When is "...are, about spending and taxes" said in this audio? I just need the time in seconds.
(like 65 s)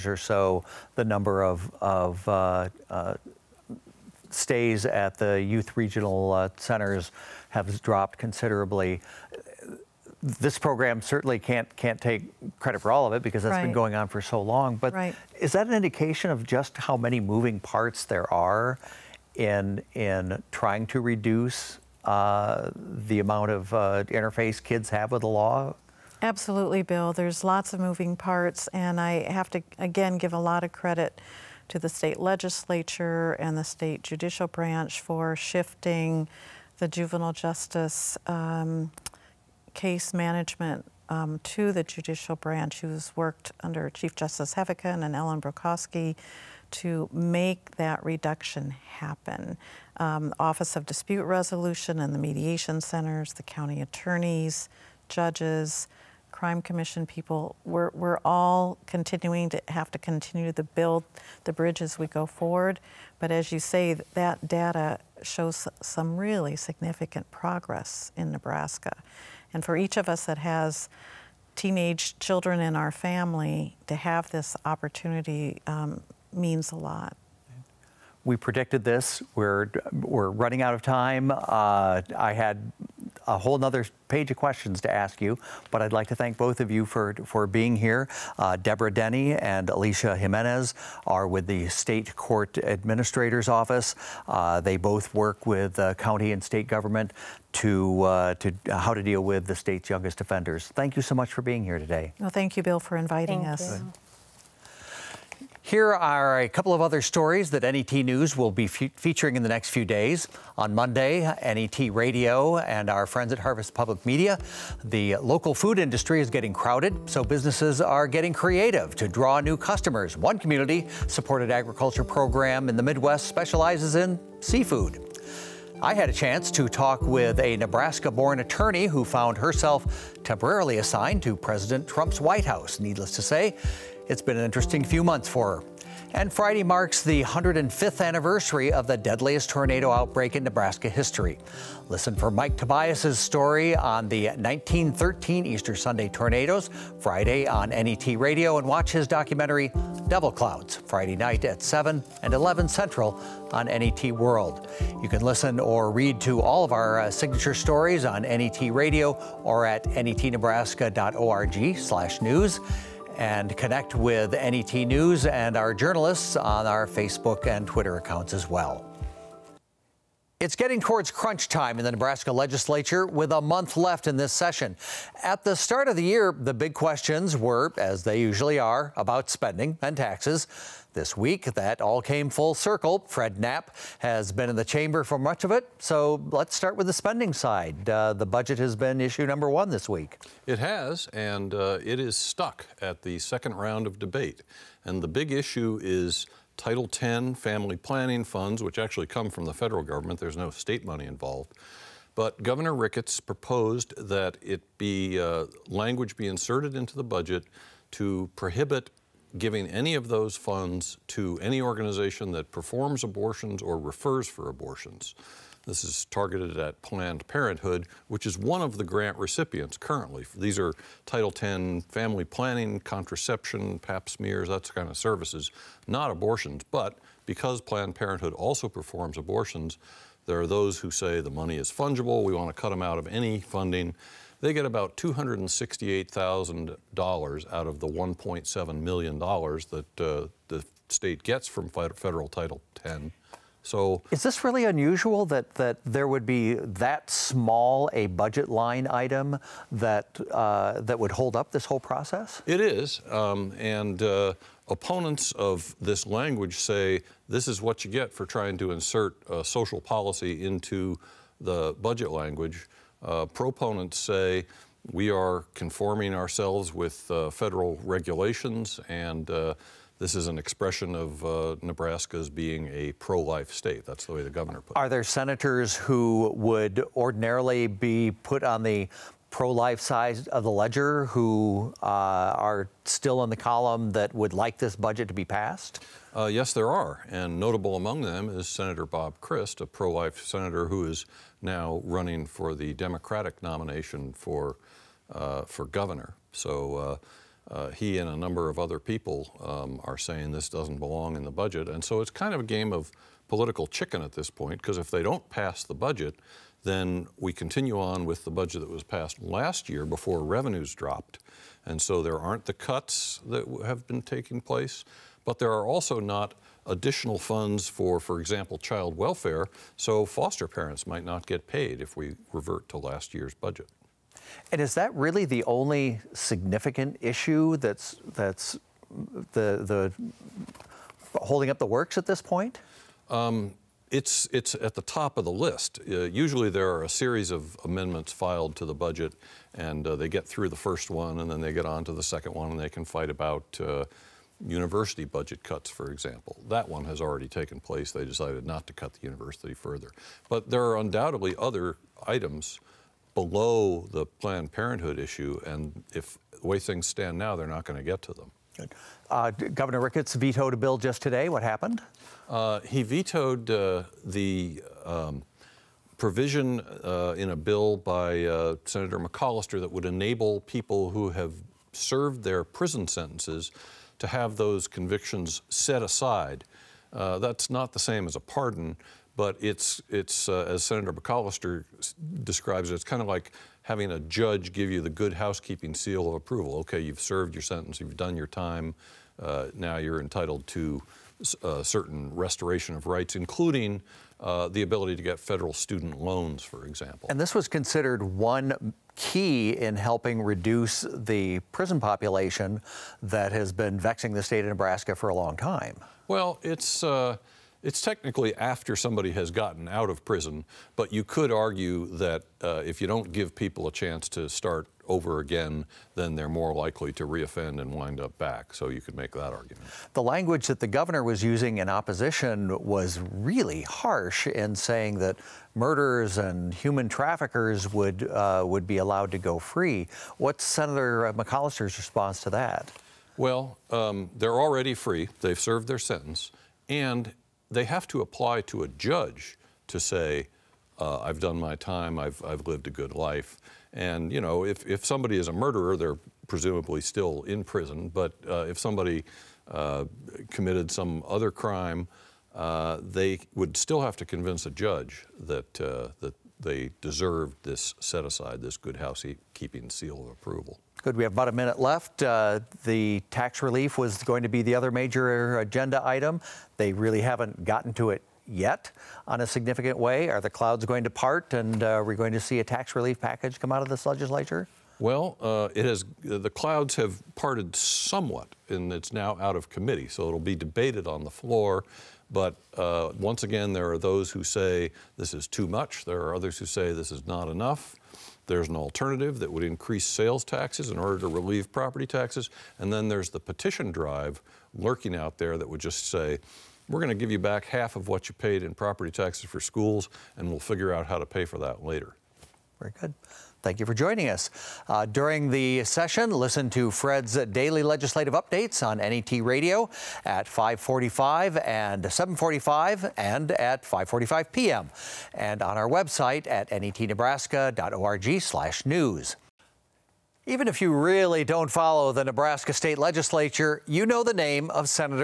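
178 s.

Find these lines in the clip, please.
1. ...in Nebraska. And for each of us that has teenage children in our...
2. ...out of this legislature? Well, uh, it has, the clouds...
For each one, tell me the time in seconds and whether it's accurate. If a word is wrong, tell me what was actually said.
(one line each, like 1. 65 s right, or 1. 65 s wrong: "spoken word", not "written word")
1. 68 s right
2. 473 s right.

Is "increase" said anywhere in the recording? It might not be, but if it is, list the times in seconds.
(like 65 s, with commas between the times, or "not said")
489 s.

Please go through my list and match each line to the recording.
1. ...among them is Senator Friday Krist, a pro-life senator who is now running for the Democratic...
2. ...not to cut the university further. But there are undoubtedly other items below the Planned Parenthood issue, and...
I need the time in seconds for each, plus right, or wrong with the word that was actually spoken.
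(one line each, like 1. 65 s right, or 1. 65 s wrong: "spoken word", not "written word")
1. 287 s wrong: "Bob", not "Friday"
2. 348 s right.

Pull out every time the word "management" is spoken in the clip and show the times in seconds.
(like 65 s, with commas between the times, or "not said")
40 s.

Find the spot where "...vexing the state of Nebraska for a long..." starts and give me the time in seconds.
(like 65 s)
403 s.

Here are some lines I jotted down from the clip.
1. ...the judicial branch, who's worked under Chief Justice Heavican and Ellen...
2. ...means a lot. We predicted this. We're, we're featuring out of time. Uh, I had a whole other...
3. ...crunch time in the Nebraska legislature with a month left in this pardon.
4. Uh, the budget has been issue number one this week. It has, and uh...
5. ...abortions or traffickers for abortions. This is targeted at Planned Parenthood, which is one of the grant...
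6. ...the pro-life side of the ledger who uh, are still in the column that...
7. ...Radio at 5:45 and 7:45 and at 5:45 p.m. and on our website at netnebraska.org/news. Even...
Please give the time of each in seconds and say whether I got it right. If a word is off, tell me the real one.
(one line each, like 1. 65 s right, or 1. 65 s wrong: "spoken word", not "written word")
1. 41 s right
2. 76 s wrong: "running", not "featuring"
3. 171 s wrong: "session", not "pardon"
4. 187 s right
5. 213 s wrong: "refers", not "traffickers"
6. 278 s right
7. 509 s right.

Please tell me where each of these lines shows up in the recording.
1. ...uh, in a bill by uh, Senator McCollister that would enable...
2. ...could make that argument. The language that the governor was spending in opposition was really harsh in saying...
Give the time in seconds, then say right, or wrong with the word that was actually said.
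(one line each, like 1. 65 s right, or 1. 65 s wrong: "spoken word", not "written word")
1. 366 s right
2. 418 s wrong: "using", not "spending".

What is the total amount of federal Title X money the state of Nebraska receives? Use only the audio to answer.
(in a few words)
$1.7 million.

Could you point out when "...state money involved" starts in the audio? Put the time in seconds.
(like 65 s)
200 s.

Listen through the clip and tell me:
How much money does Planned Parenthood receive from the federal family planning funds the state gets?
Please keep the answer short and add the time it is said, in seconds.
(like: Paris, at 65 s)
$268,000, at 234 s.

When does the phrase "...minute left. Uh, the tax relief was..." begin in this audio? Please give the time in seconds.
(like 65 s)
461 s.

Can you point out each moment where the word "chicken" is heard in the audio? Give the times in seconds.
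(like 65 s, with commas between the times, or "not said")
303 s.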